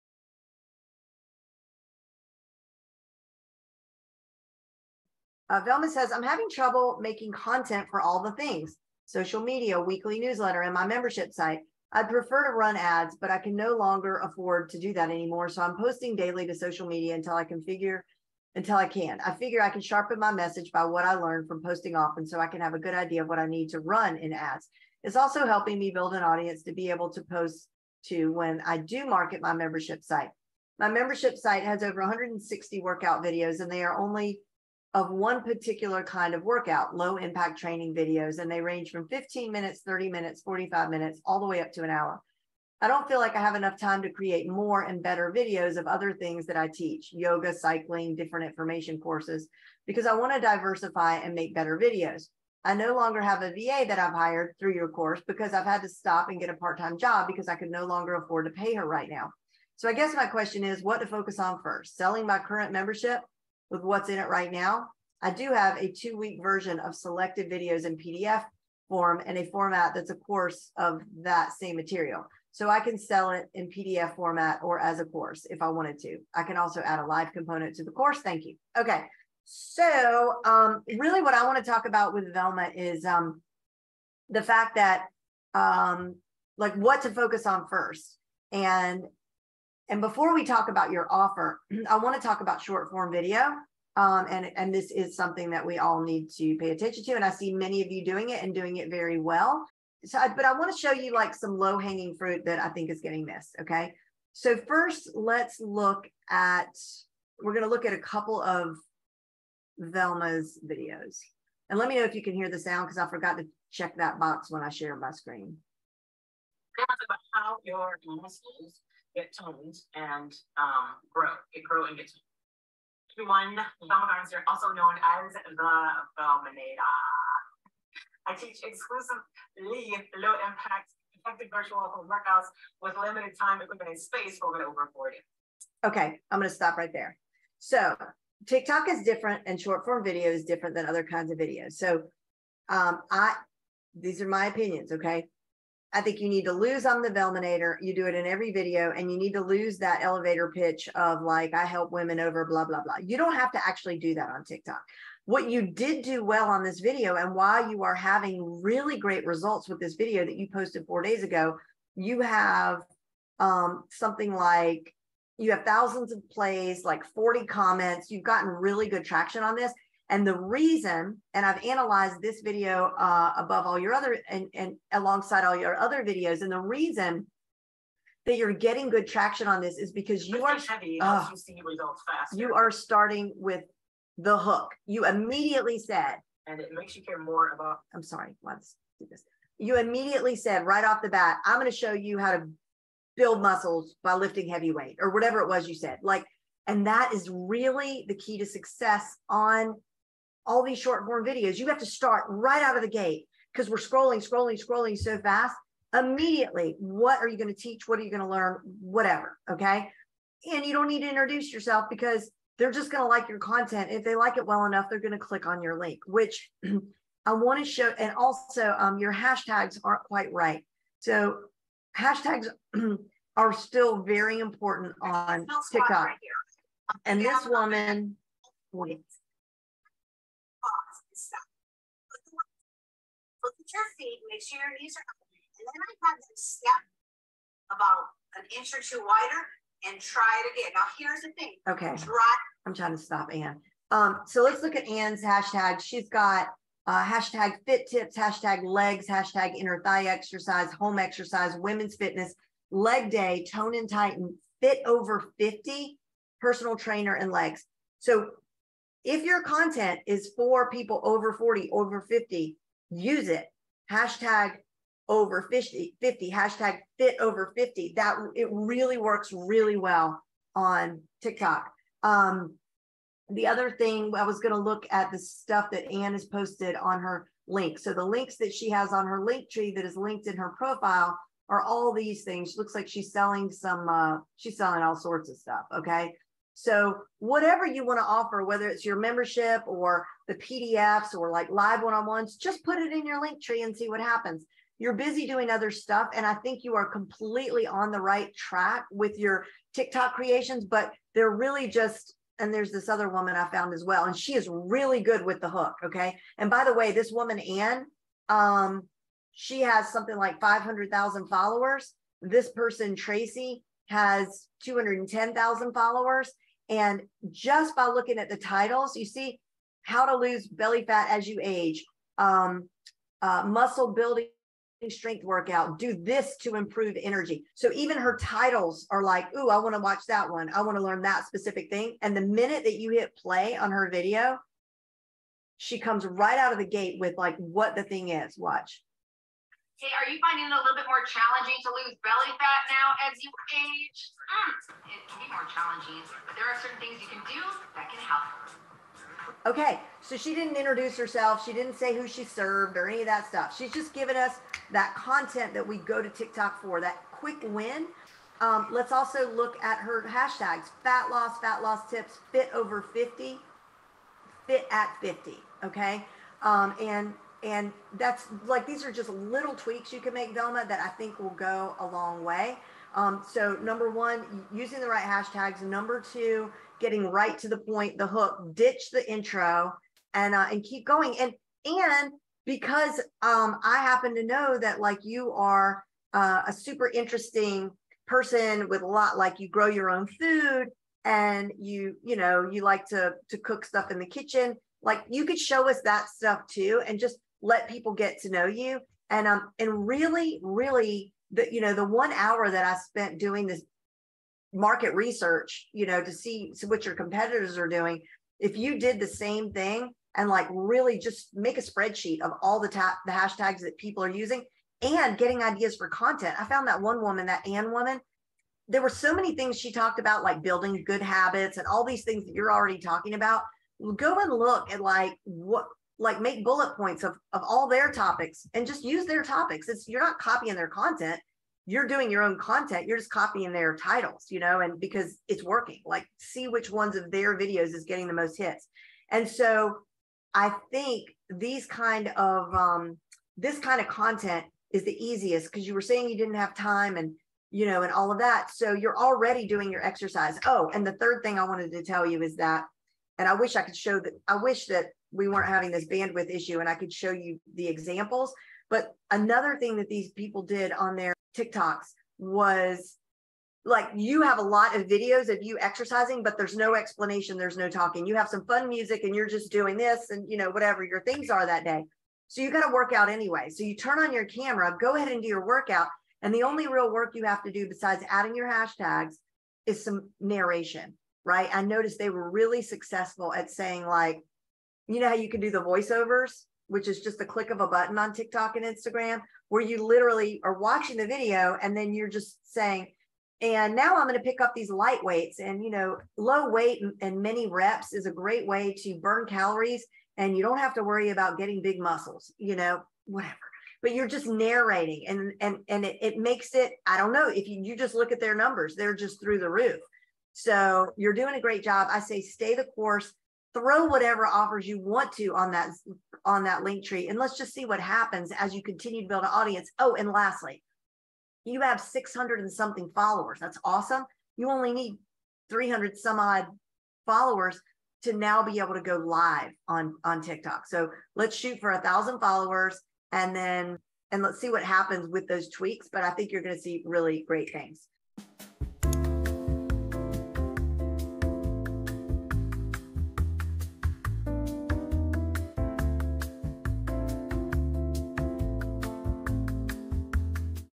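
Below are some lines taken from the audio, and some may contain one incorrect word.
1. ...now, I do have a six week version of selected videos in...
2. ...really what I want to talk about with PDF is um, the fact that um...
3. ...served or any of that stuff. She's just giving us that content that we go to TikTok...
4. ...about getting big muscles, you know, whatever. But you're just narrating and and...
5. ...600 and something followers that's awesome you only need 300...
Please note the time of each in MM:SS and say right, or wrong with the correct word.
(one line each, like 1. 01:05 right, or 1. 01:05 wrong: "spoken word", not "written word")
1. 01:04 wrong: "two", not "six"
2. 01:20 wrong: "Velma", not "PDF"
3. 05:52 right
4. 08:21 right
5. 08:41 right.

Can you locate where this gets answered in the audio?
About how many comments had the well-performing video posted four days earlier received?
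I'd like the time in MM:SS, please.
02:46.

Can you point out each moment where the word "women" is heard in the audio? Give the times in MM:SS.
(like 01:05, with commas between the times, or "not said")
02:31, 04:11.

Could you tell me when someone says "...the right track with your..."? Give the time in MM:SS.
04:57.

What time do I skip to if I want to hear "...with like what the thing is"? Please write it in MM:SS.
05:37.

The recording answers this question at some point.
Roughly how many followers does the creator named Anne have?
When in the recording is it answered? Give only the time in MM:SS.
05:10.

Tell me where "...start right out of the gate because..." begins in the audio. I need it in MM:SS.
03:21.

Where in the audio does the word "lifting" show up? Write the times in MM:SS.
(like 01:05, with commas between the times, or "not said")
03:14.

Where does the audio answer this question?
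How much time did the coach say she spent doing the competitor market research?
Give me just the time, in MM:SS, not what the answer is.
06:41.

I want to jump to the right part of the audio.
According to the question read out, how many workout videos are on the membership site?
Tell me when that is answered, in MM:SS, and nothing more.
00:31.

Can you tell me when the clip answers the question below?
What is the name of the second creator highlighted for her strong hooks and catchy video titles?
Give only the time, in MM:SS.
05:12.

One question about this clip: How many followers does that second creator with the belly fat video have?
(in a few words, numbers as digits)
210,000.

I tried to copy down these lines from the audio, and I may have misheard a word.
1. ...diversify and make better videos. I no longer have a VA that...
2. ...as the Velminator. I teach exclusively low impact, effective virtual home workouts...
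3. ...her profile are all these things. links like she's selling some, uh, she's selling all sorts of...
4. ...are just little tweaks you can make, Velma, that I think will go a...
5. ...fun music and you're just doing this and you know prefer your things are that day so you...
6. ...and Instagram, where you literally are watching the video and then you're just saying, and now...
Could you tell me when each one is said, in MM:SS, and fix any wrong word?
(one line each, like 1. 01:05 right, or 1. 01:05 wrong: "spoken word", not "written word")
1. 00:50 right
2. 02:05 right
3. 04:40 wrong: "looks", not "links"
4. 06:08 right
5. 07:48 wrong: "whatever", not "prefer"
6. 08:08 right.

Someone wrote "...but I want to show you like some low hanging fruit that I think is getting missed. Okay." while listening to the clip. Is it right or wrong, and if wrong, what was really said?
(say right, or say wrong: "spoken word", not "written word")
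right.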